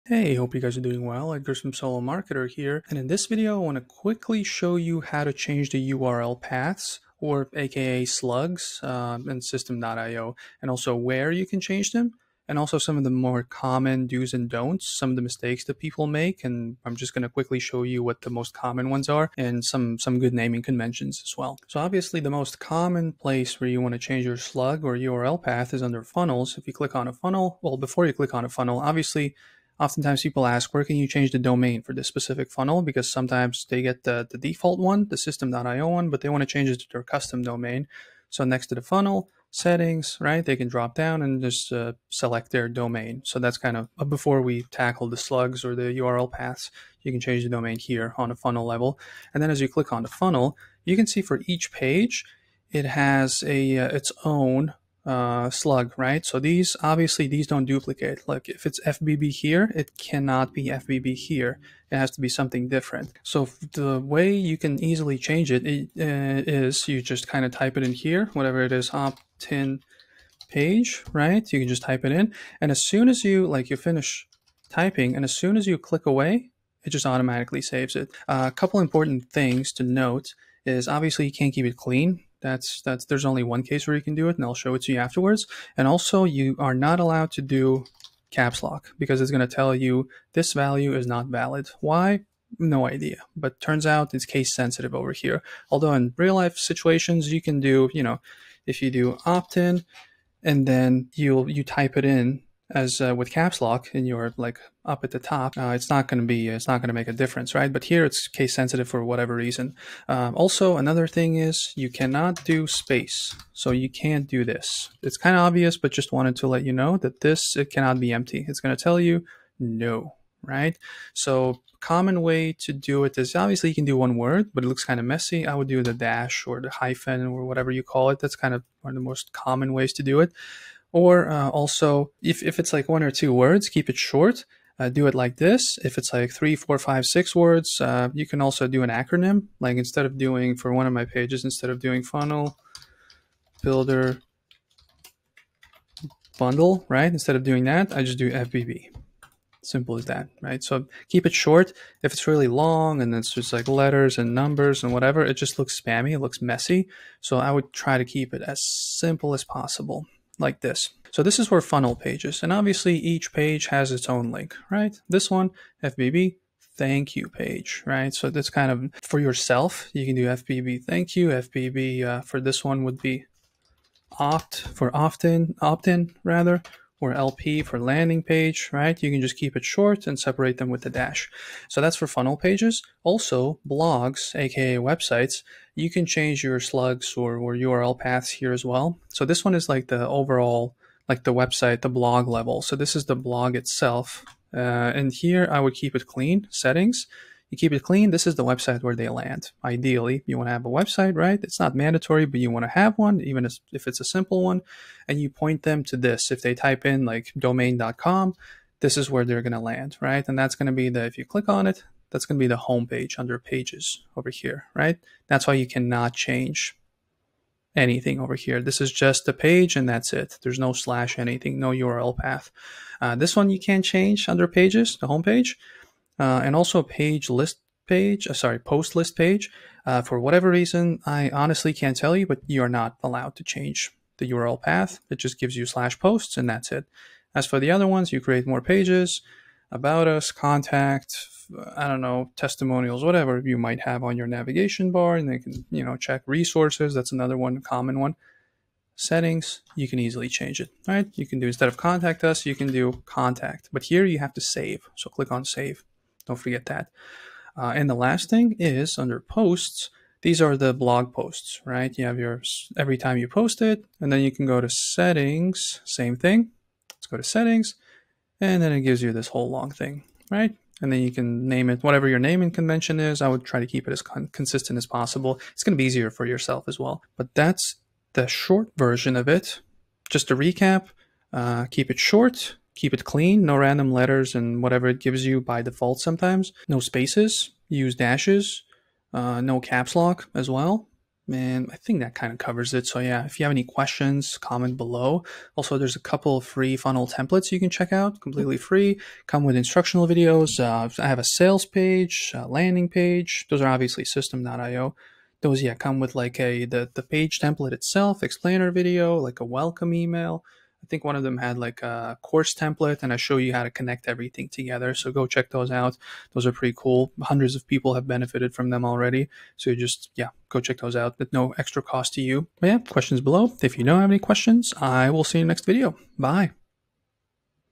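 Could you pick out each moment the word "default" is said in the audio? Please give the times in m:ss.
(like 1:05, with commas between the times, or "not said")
0:34, 4:45.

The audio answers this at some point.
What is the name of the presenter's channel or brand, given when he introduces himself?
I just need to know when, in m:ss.
0:01.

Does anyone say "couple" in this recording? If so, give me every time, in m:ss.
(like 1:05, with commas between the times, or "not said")
1:18, 4:55.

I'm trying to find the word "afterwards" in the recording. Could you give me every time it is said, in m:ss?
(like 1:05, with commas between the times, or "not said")
1:24.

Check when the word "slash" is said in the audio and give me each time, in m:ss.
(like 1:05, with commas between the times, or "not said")
3:40, 3:55.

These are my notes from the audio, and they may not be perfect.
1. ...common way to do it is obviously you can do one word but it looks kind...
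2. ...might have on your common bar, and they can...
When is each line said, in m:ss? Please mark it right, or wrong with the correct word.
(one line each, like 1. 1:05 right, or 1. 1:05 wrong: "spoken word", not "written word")
1. 2:01 right
2. 4:03 wrong: "navigation", not "common".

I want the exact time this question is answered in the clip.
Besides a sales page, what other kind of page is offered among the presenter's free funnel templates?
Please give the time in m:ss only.
5:02.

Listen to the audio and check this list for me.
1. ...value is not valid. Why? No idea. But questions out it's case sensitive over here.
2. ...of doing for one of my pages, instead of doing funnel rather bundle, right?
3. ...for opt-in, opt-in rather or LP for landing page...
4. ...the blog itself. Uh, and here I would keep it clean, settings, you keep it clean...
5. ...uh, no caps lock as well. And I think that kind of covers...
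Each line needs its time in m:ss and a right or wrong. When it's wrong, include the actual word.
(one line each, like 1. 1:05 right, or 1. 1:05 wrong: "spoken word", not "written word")
1. 1:30 wrong: "turns", not "questions"
2. 2:20 wrong: "builder", not "rather"
3. 2:54 right
4. 3:13 right
5. 4:49 right.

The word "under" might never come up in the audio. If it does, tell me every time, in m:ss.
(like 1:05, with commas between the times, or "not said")
0:25, 3:33, 3:44, 4:18.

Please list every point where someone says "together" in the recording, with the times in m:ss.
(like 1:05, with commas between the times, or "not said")
5:14.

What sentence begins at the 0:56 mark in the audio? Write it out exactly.
So these, obviously these don't duplicate.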